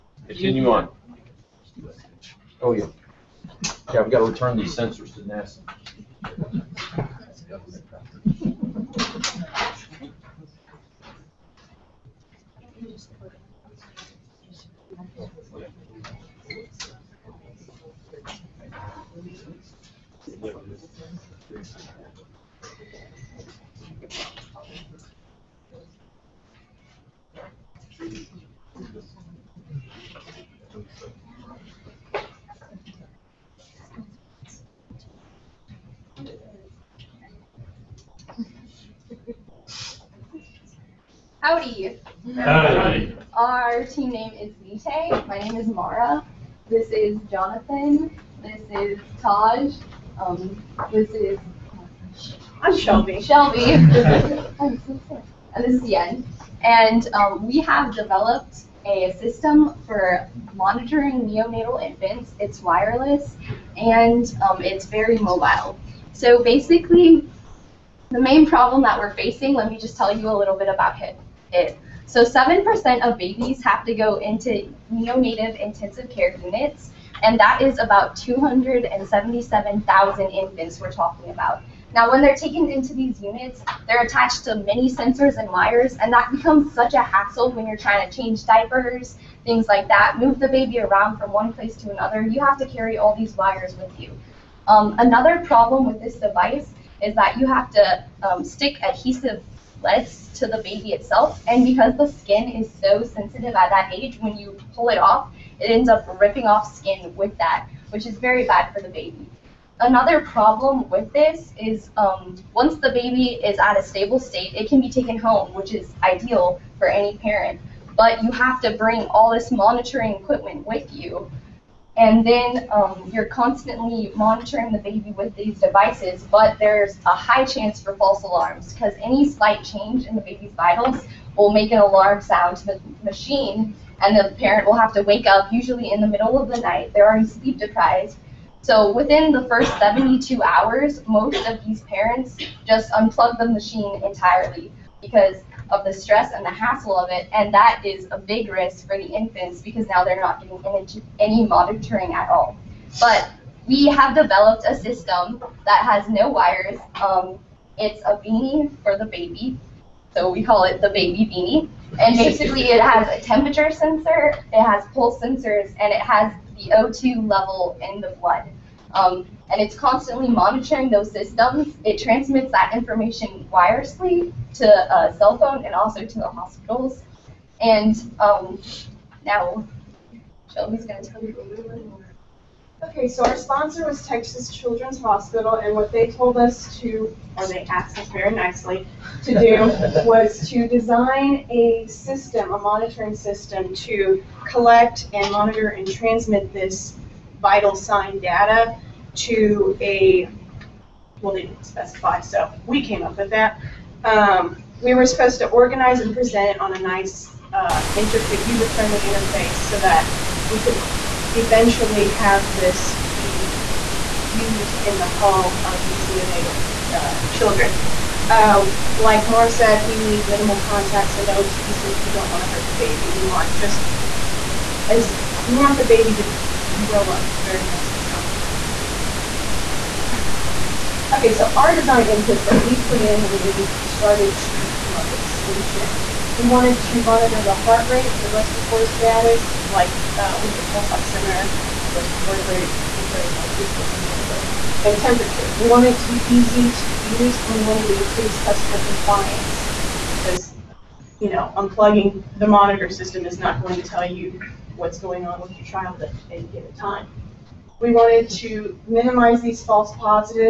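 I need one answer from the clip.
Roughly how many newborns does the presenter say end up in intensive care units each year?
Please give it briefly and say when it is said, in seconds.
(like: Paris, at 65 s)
277,000, at 78 s.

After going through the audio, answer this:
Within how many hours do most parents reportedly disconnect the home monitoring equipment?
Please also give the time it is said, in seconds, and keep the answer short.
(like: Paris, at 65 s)
72, at 139 s.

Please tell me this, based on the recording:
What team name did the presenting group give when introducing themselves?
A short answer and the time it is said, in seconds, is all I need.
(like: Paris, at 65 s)
Vite, at 44 s.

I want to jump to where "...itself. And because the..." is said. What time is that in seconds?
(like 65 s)
100 s.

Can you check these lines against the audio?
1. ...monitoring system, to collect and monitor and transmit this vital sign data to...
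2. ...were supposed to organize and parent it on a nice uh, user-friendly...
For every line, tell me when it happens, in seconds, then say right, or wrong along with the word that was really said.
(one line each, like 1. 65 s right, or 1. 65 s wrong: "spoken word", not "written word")
1. 192 s right
2. 204 s wrong: "present", not "parent".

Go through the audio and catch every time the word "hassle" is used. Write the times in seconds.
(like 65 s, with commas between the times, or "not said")
87 s, 146 s.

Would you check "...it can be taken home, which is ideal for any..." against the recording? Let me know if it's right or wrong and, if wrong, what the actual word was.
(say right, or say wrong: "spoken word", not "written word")
right.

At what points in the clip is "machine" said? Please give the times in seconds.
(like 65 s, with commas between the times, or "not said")
133 s, 143 s.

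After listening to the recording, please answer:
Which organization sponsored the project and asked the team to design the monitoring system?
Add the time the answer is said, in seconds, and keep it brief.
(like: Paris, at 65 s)
Texas Children's Hospital, at 184 s.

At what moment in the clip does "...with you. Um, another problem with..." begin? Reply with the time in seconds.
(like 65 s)
93 s.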